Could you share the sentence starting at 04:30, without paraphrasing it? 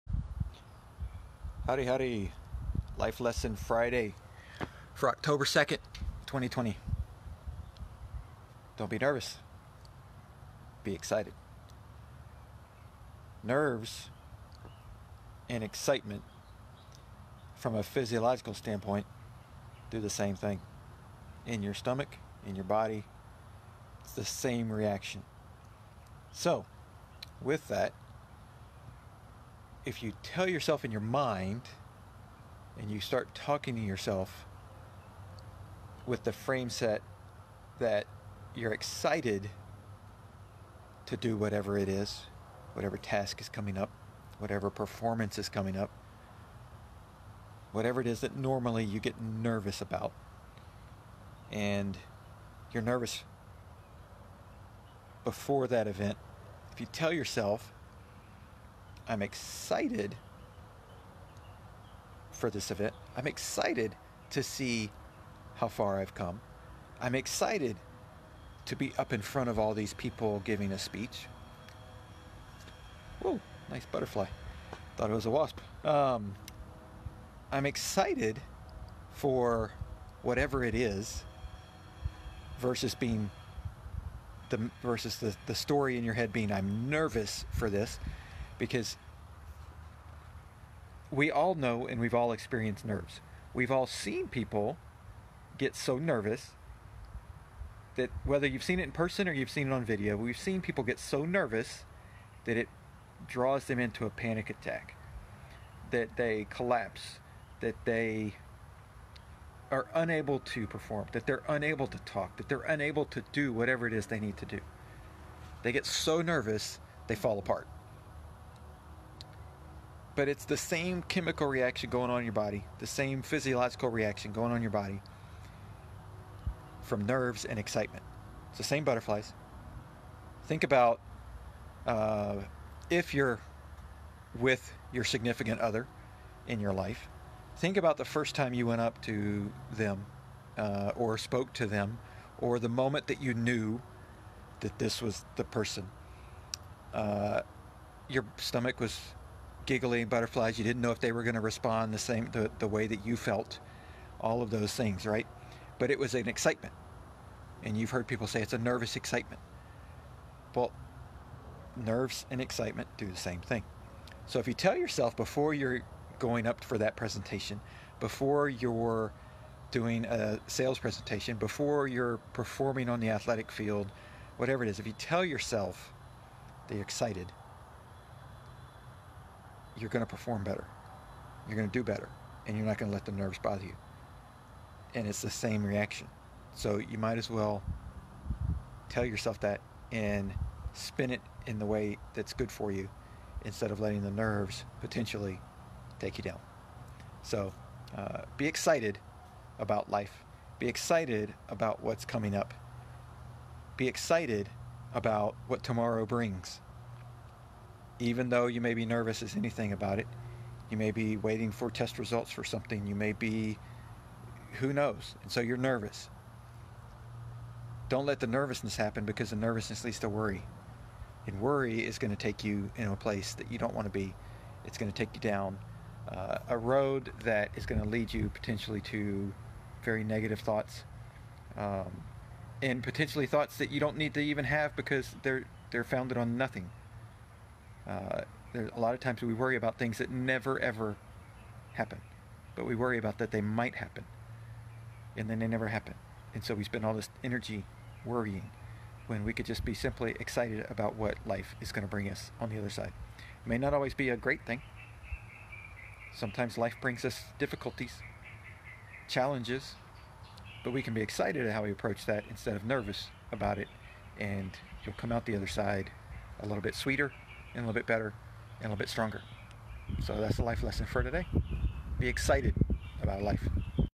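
So that's the life lesson for today.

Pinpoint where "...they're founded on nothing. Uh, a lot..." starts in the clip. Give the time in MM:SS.
03:55.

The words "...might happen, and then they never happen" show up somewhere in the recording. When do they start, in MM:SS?
04:03.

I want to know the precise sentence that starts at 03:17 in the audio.
So uh, be excited about life.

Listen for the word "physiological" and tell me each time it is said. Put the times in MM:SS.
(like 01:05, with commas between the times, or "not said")
00:17, 02:03.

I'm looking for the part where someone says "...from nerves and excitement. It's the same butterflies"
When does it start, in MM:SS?
02:06.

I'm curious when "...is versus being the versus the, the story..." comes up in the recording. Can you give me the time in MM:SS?
01:20.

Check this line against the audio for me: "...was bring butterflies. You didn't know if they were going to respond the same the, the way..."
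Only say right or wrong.
wrong.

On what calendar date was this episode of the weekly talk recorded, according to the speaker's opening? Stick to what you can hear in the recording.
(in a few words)
October 2, 2020.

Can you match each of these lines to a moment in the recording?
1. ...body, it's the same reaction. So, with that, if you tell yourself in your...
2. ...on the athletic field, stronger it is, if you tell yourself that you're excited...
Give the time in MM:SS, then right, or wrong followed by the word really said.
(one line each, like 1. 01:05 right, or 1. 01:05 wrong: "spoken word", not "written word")
1. 00:22 right
2. 02:52 wrong: "whatever", not "stronger".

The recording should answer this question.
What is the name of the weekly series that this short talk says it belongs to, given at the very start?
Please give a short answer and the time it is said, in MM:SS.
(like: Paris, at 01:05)
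Life Lesson Friday, at 00:02.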